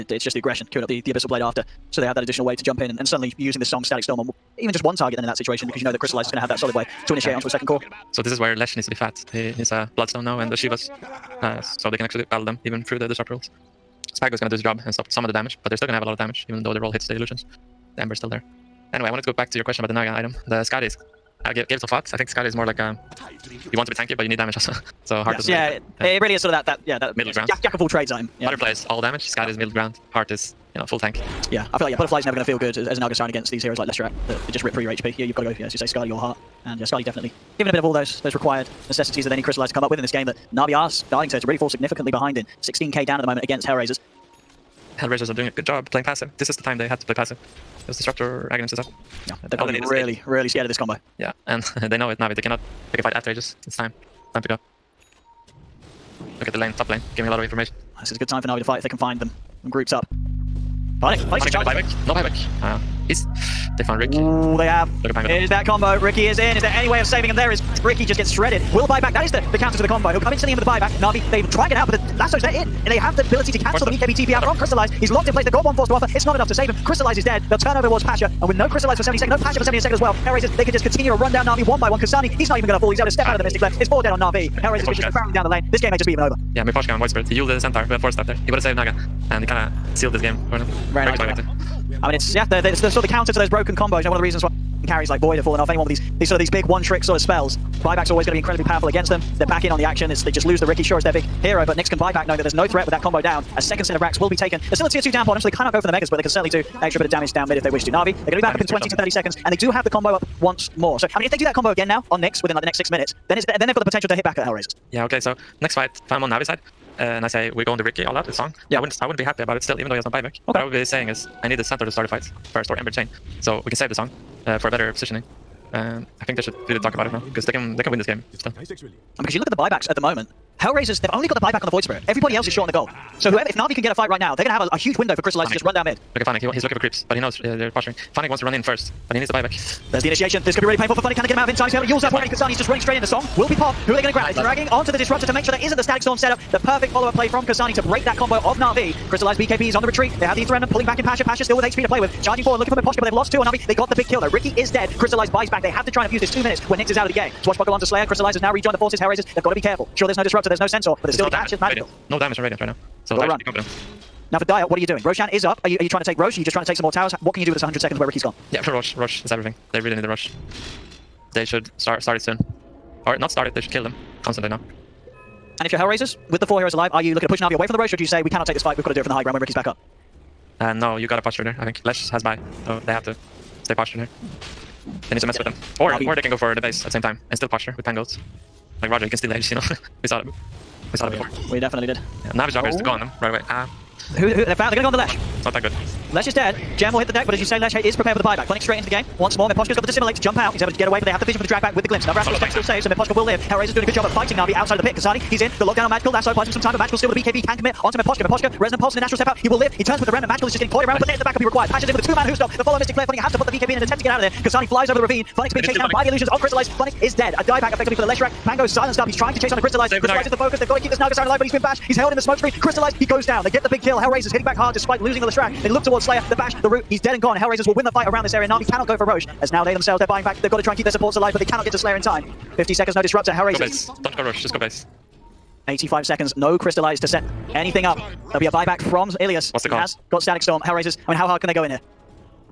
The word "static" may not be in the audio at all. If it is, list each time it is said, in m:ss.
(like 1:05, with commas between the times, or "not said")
0:03, 2:25, 4:00.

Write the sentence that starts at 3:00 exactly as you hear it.
Uh, no, you got a posture there, I think.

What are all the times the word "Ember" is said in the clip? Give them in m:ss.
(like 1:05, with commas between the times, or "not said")
0:18, 2:02.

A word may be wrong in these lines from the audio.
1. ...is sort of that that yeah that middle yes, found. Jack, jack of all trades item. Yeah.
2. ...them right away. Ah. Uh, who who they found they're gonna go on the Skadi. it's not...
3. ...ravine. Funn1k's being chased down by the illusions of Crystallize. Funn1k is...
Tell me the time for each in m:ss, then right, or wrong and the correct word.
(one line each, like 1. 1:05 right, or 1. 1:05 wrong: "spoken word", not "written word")
1. 0:26 wrong: "ground", not "found"
2. 3:12 wrong: "Lesh", not "Skadi"
3. 3:35 right.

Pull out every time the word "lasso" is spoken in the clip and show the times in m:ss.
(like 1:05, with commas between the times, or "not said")
1:12, 3:26.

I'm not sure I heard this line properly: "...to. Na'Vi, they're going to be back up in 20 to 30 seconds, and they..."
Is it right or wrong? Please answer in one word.
right.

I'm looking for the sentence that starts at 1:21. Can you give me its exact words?
Kasani, he's not even going to fall.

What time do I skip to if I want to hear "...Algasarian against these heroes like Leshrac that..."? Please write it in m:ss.
0:33.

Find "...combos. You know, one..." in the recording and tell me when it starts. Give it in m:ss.
1:33.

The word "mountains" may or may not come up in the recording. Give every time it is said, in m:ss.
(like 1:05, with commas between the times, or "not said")
not said.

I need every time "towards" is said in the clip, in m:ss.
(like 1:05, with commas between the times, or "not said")
1:17, 3:45.